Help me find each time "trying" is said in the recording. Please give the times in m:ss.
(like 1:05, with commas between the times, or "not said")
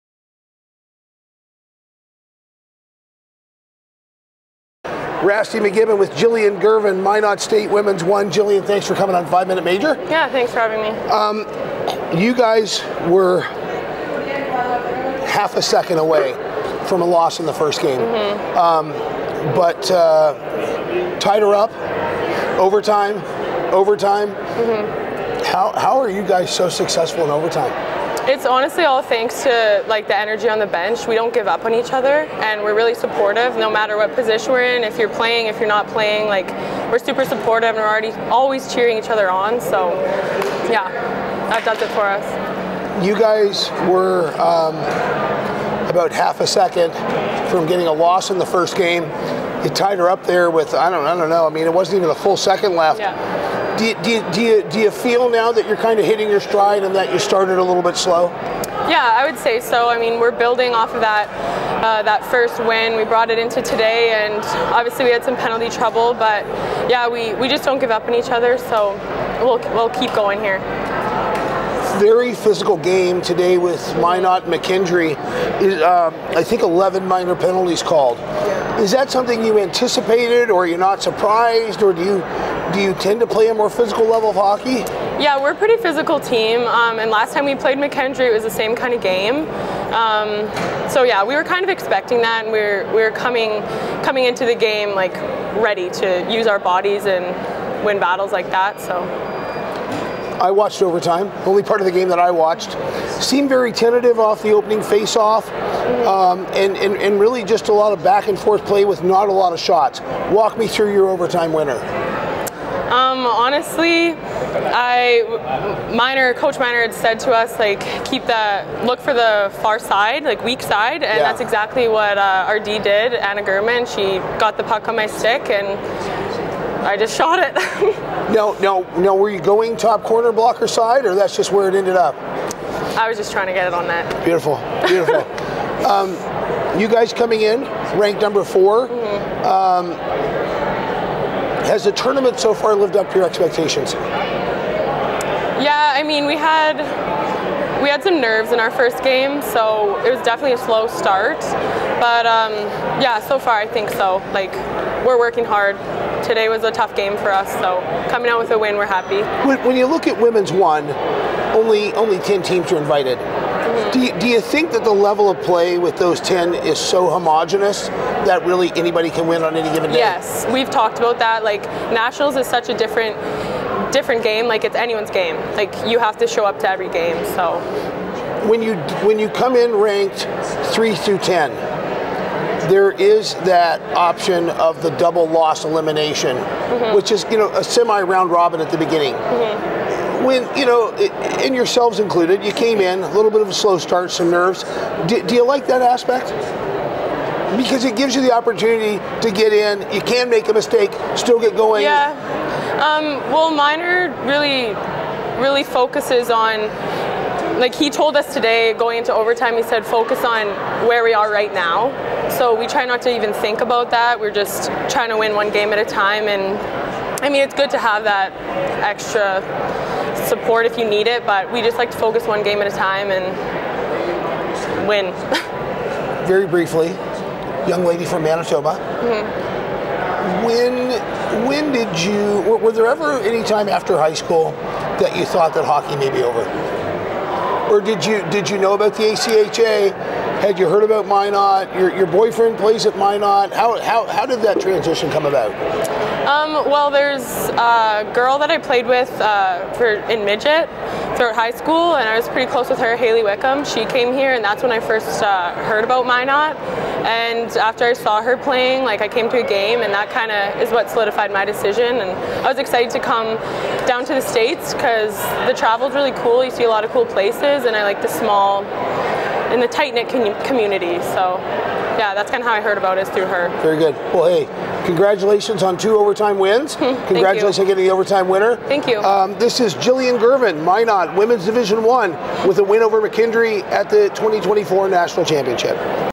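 2:13, 3:34.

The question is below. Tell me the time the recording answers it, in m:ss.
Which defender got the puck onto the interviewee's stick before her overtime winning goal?
2:03.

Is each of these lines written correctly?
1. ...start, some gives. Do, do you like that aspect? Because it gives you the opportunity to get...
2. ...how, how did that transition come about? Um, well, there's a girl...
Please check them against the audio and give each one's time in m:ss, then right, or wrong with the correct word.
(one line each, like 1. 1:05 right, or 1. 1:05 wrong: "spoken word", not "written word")
1. 3:13 wrong: "nerves", not "gives"
2. 4:03 right.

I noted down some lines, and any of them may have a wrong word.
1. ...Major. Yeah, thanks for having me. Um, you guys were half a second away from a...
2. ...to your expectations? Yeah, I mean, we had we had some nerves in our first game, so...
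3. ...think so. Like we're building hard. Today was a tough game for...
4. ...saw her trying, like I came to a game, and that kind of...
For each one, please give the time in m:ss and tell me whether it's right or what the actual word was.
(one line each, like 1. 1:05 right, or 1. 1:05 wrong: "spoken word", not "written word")
1. 0:09 right
2. 2:23 right
3. 2:33 wrong: "working", not "building"
4. 4:17 wrong: "playing", not "trying".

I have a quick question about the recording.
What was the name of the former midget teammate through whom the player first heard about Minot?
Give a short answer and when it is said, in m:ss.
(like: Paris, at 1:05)
Haley Wickham, at 4:12.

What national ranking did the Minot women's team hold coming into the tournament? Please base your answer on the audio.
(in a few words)
4.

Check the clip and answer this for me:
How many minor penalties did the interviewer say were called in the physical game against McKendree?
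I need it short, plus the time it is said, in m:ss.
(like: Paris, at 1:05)
11, at 1:16.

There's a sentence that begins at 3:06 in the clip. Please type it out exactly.
which is you know a semi round robin at the beginning.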